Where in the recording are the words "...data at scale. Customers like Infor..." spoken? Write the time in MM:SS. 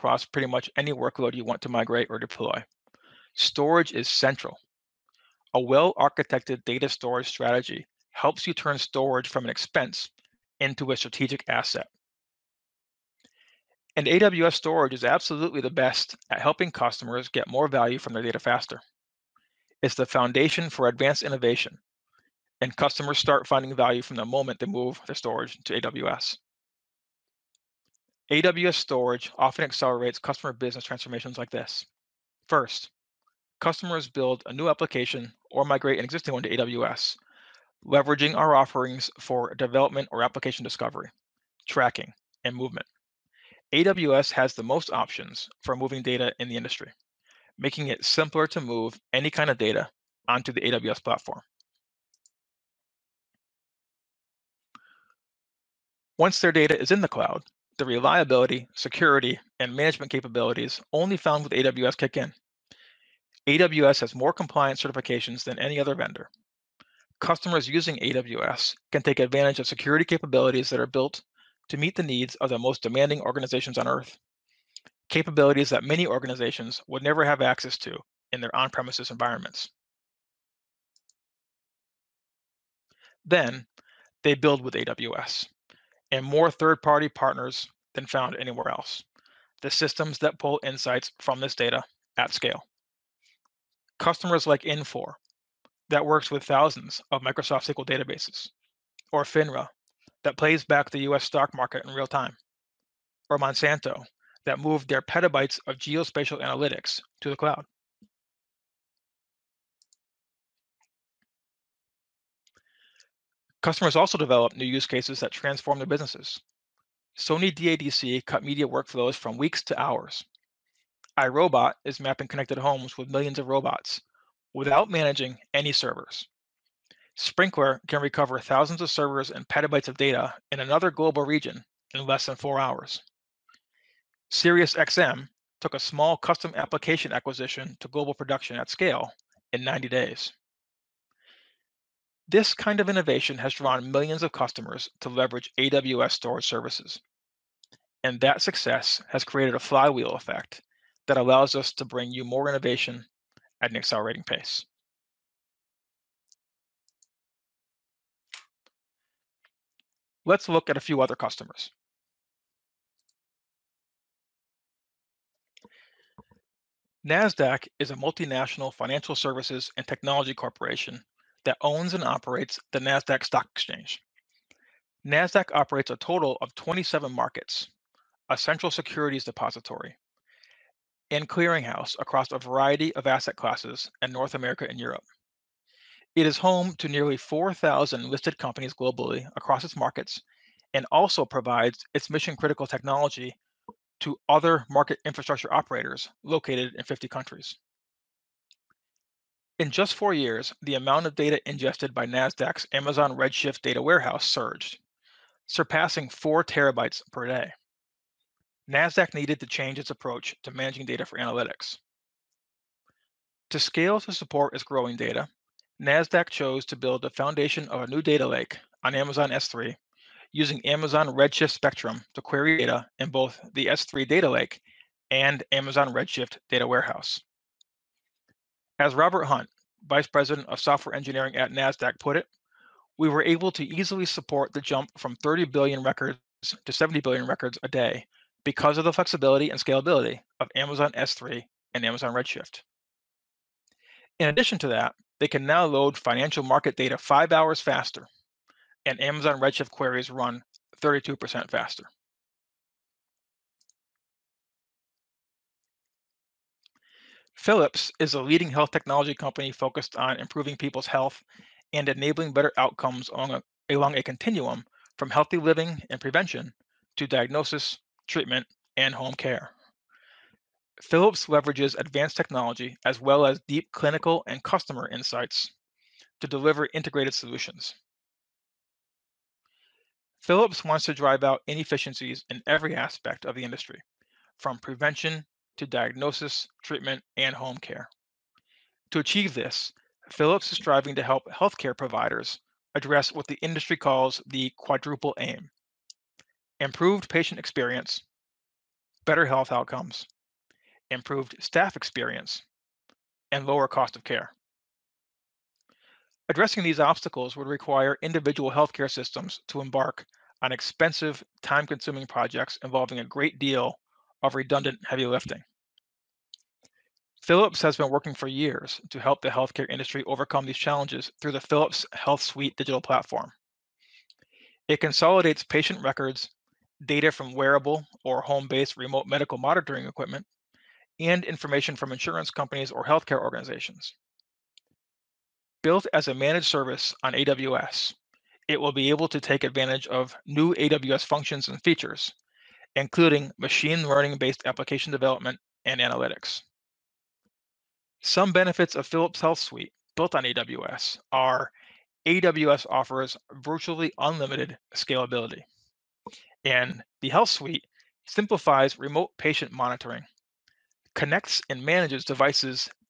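01:31.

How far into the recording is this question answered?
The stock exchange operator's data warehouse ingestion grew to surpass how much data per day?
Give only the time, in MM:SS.
03:26.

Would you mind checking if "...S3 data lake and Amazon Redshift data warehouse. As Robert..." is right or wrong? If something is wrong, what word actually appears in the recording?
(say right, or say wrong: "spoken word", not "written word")
right.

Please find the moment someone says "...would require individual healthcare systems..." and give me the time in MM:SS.
05:07.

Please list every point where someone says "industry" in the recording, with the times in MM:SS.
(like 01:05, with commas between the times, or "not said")
00:46, 04:43, 04:53, 05:19.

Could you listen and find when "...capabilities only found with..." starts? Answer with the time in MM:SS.
01:00.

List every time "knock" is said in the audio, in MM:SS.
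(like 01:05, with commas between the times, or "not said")
not said.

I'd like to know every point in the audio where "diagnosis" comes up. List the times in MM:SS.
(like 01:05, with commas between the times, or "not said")
04:27, 04:45.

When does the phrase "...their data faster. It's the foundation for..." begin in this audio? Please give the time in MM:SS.
00:18.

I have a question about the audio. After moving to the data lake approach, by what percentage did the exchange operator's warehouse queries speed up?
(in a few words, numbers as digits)
32%.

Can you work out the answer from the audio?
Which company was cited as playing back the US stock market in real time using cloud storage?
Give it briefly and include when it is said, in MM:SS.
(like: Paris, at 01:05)
FINRA, at 01:39.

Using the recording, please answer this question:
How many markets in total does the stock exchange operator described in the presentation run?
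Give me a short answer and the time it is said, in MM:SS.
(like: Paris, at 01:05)
27, at 02:56.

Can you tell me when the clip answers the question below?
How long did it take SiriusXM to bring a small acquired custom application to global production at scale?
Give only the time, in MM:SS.
02:19.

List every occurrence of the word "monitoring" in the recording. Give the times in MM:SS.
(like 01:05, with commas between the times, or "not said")
05:29, 05:59.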